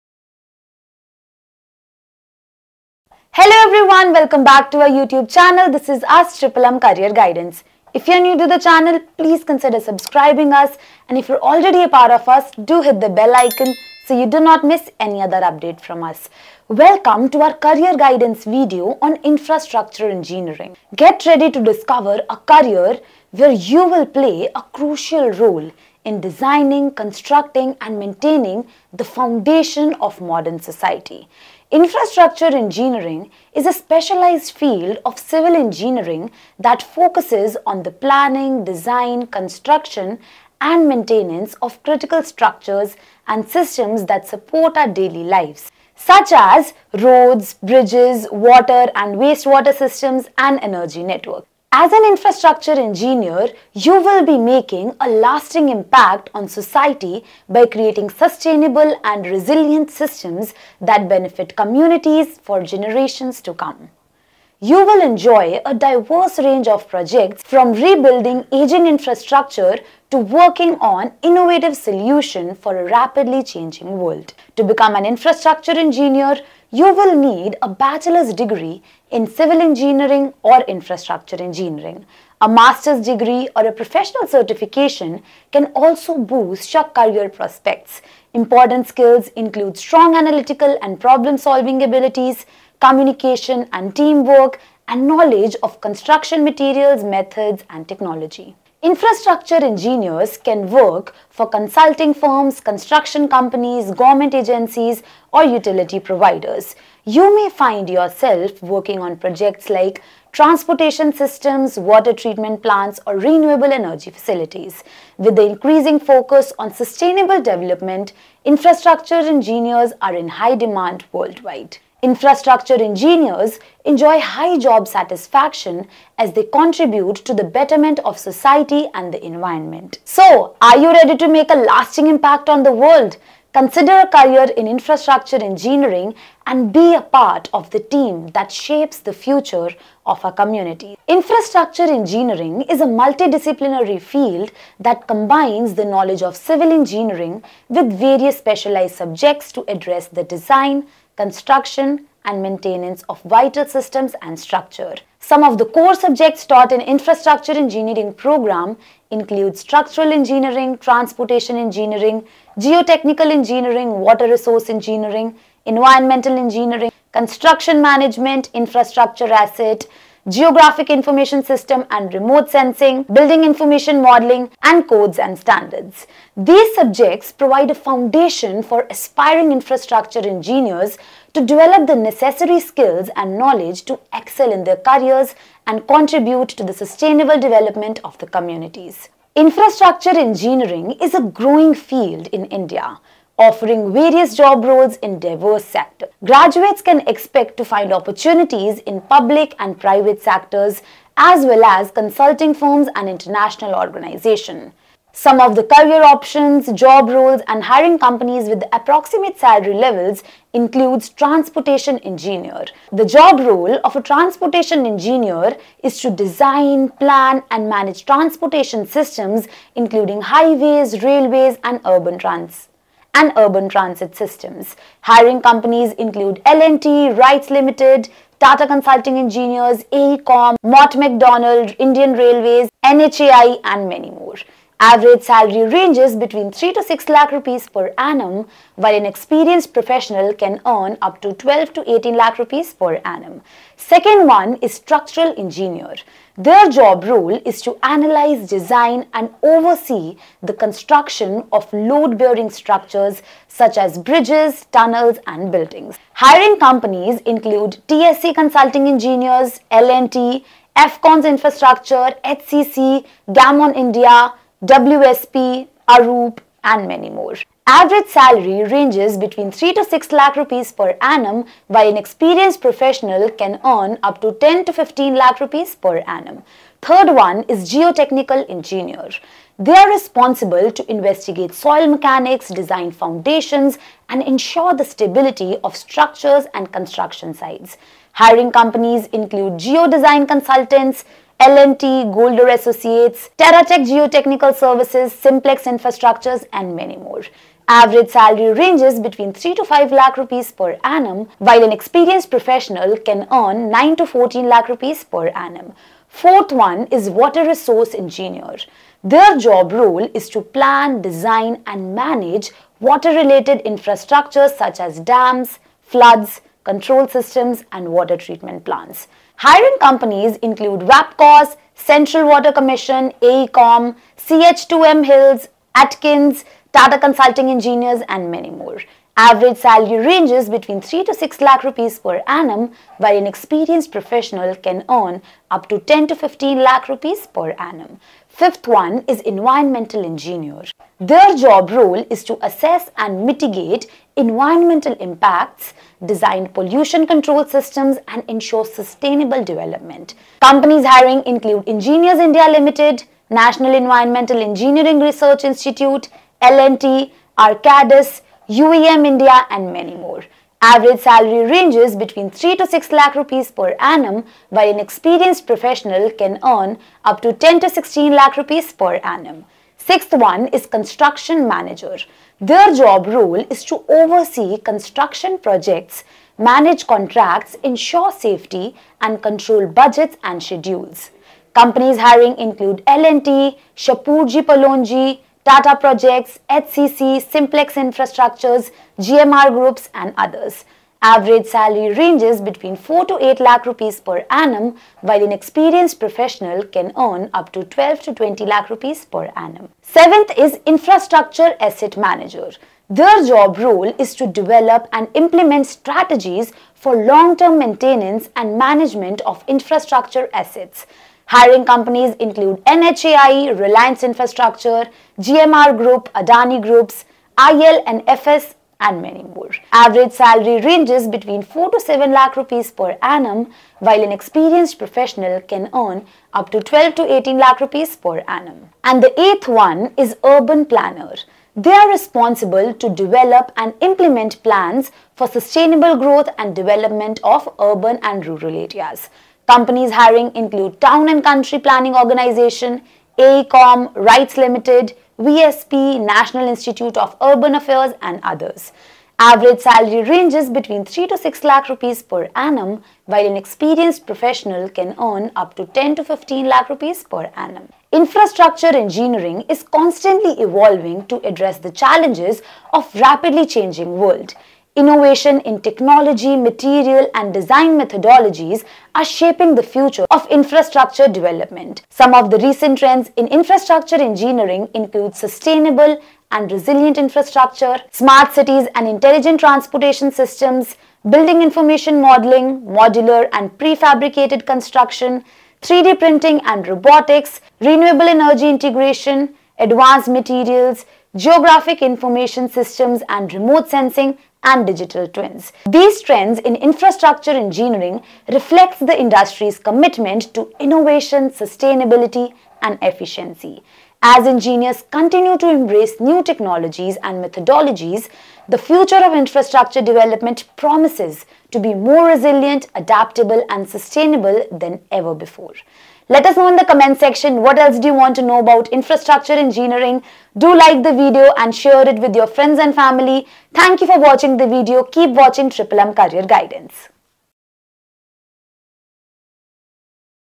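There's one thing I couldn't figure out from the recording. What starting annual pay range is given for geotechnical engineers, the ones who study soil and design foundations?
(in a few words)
3 to 5 lakh.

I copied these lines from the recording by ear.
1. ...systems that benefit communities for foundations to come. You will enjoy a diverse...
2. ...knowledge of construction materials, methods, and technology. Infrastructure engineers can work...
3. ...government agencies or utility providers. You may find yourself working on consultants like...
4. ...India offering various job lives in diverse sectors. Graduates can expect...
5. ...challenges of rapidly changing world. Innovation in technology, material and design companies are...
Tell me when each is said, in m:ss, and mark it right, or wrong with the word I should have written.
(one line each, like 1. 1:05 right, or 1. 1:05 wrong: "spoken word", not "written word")
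1. 0:59 wrong: "generations", not "foundations"
2. 1:35 right
3. 1:43 wrong: "projects", not "consultants"
4. 3:12 wrong: "roles", not "lives"
5. 7:41 wrong: "methodologies", not "companies".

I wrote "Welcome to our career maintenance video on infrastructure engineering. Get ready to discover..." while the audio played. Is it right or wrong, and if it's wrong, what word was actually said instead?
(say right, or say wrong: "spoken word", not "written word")
wrong: "guidance", not "maintenance".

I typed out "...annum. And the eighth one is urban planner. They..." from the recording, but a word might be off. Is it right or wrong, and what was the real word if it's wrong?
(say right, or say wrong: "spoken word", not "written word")
right.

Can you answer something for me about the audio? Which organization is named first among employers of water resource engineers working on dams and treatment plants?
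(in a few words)
WAPCOS.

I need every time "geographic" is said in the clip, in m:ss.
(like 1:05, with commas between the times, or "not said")
2:50, 8:11.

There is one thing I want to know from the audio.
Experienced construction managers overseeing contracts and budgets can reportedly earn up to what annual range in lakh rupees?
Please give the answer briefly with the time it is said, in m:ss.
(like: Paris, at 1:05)
12 to 20 lakh, at 6:37.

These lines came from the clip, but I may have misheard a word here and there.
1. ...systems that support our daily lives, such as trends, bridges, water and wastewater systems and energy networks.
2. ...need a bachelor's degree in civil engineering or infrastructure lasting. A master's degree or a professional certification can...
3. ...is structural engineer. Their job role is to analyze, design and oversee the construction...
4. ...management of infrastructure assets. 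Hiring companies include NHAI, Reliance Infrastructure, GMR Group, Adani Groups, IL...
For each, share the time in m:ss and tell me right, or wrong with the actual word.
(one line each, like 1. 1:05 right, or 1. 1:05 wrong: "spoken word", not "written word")
1. 0:43 wrong: "roads", not "trends"
2. 1:17 wrong: "engineering", not "lasting"
3. 4:04 right
4. 6:48 right.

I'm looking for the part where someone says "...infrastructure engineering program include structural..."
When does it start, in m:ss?
2:36.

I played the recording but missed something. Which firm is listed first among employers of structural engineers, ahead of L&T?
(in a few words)
TSC Consulting Engineers.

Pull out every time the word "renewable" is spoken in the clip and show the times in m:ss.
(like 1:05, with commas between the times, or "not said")
1:53, 8:07.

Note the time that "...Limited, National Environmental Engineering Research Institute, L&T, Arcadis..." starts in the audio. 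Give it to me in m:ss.
5:52.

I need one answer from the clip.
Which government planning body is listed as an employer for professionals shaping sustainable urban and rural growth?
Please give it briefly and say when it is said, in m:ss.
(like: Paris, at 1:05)
Town and Country Planning Organization, at 7:20.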